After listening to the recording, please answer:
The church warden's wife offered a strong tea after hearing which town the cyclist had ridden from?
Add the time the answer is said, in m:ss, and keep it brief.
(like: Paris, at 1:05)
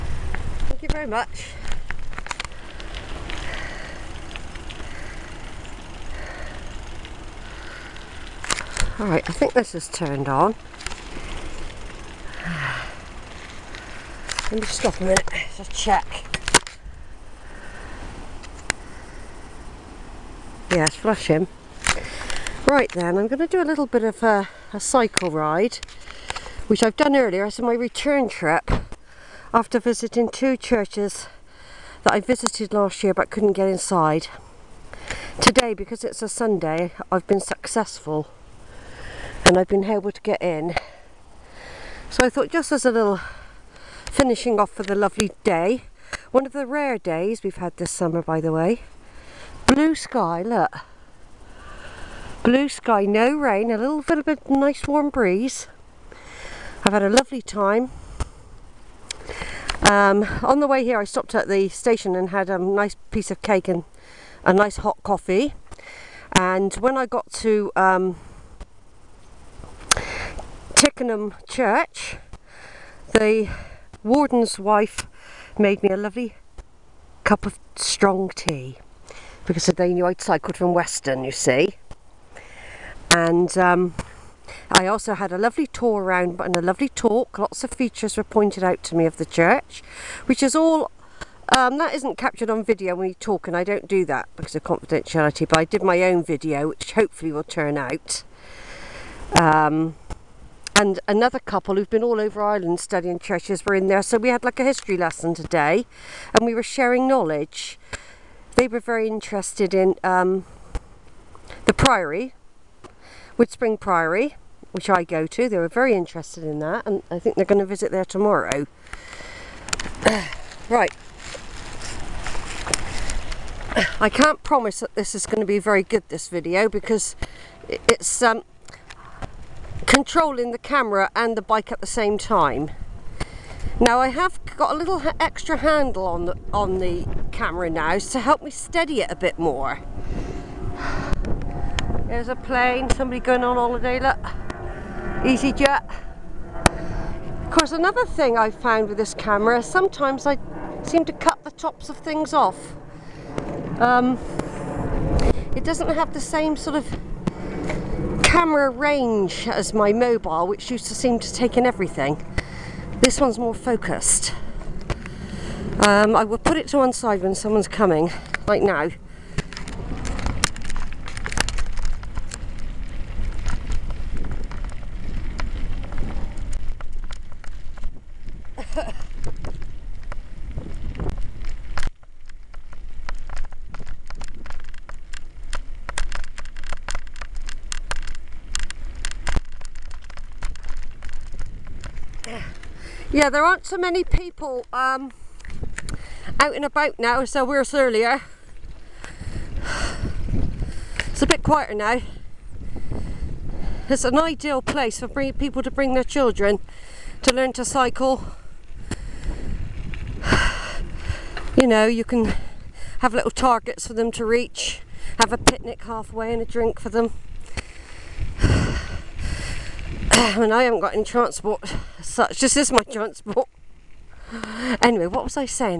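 Weston, at 1:20.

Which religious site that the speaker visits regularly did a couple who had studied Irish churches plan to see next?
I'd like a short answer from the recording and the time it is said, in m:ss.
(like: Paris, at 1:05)
Woodspring Priory, at 1:53.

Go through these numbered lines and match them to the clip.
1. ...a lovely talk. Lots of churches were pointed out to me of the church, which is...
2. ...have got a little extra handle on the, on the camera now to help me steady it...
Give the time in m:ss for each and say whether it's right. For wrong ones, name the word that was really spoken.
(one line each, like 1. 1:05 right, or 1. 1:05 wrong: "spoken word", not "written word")
1. 1:26 wrong: "features", not "churches"
2. 2:14 right.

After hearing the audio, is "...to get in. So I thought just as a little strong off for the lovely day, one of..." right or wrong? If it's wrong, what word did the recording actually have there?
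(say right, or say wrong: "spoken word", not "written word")
wrong: "finishing", not "strong".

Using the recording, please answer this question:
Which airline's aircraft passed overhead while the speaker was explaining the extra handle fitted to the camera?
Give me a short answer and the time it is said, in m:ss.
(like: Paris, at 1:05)
EasyJet, at 2:25.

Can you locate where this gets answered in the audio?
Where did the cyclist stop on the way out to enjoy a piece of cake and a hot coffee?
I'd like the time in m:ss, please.
1:01.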